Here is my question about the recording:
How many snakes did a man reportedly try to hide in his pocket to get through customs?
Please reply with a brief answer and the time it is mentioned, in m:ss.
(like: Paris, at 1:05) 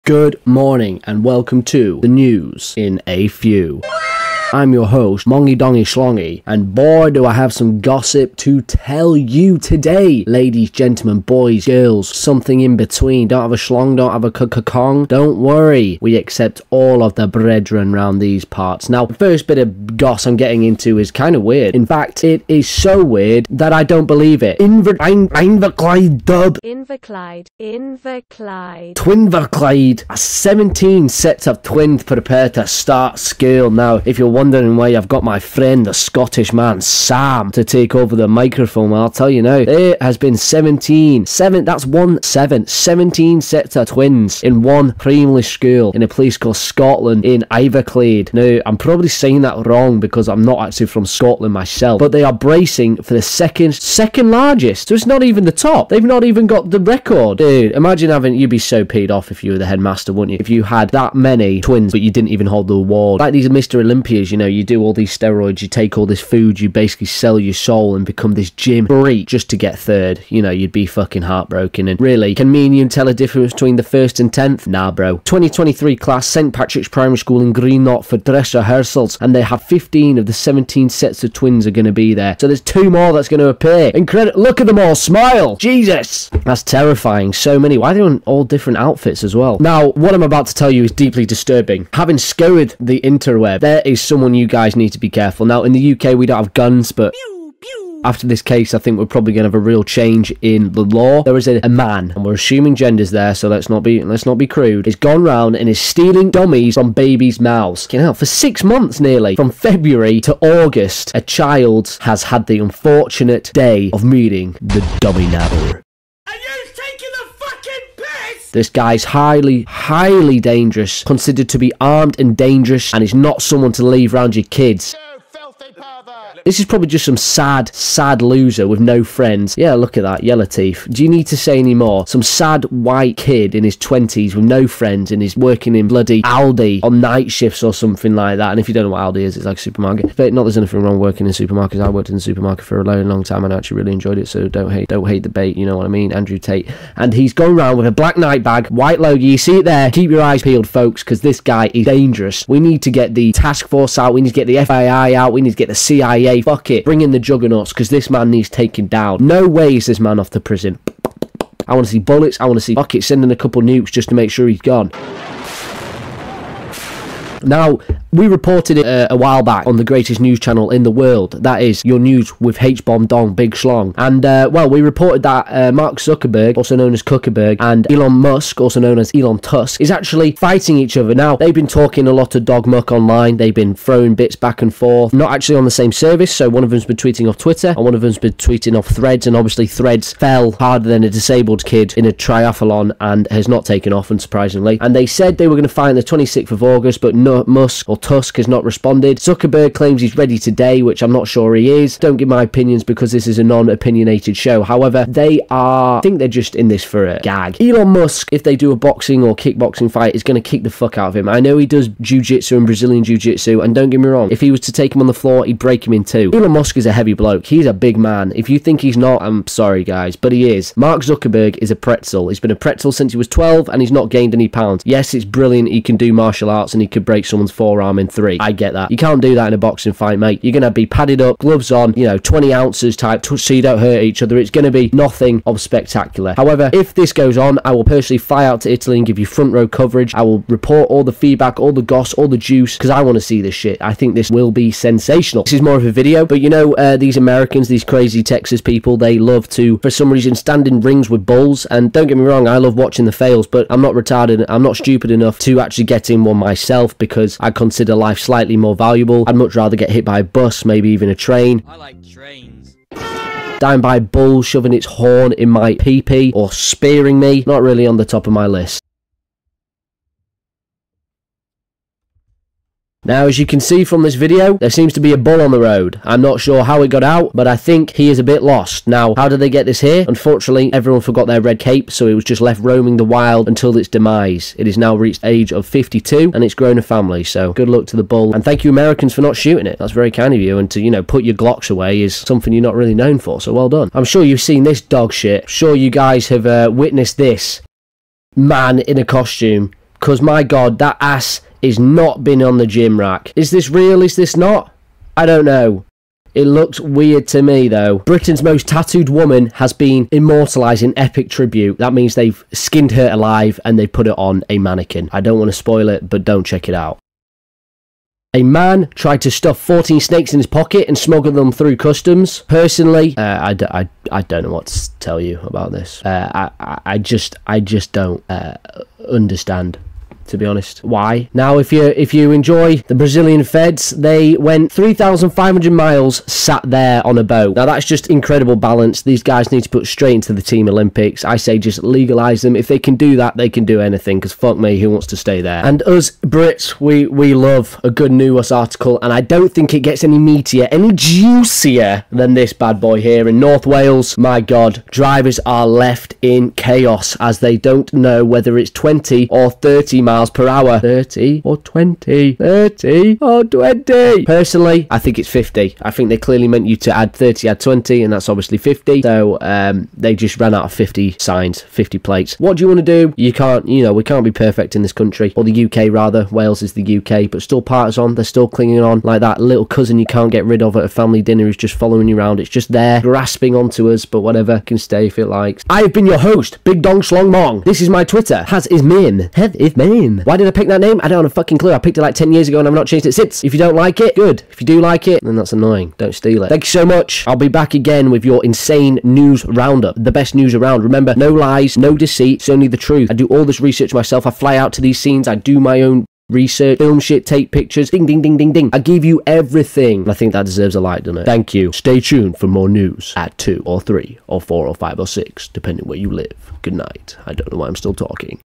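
14, at 5:19.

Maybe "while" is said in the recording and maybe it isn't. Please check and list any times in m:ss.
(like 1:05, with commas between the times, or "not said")
2:49.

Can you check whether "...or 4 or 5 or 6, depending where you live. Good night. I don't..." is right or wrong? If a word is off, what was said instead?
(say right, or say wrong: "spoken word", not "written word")
right.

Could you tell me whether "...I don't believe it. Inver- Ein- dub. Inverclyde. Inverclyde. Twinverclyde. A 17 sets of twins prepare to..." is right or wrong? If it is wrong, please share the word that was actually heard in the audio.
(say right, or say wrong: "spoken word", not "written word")
right.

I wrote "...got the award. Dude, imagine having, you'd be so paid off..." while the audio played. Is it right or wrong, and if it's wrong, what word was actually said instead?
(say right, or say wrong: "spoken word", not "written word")
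wrong: "record", not "award".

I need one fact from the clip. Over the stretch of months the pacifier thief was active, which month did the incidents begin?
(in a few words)
February.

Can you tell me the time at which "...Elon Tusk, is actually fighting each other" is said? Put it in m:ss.
2:59.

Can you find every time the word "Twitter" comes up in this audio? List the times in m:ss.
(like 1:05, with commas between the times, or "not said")
3:07, 6:28.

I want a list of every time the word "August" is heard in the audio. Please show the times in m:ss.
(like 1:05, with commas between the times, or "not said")
1:50, 3:16.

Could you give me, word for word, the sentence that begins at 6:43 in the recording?
I do all this research myself.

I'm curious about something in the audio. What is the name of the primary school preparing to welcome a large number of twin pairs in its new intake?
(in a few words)
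St. Patrick's Primary School.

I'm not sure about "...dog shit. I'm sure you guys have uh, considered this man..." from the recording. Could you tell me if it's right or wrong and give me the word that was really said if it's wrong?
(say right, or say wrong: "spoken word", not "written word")
wrong: "witnessed", not "considered".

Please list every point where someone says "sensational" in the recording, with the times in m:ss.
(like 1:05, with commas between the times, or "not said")
4:04.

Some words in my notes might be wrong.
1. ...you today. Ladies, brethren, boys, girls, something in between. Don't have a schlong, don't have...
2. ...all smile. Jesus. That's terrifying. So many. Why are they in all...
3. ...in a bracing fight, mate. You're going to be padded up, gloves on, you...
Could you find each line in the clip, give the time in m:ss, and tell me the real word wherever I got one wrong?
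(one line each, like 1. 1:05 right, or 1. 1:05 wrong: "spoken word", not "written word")
1. 0:09 wrong: "gentlemen", not "brethren"
2. 1:24 right
3. 3:49 wrong: "boxing", not "bracing".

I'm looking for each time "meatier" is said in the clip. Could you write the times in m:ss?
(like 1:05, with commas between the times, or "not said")
5:50.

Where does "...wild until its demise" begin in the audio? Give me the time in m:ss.
4:43.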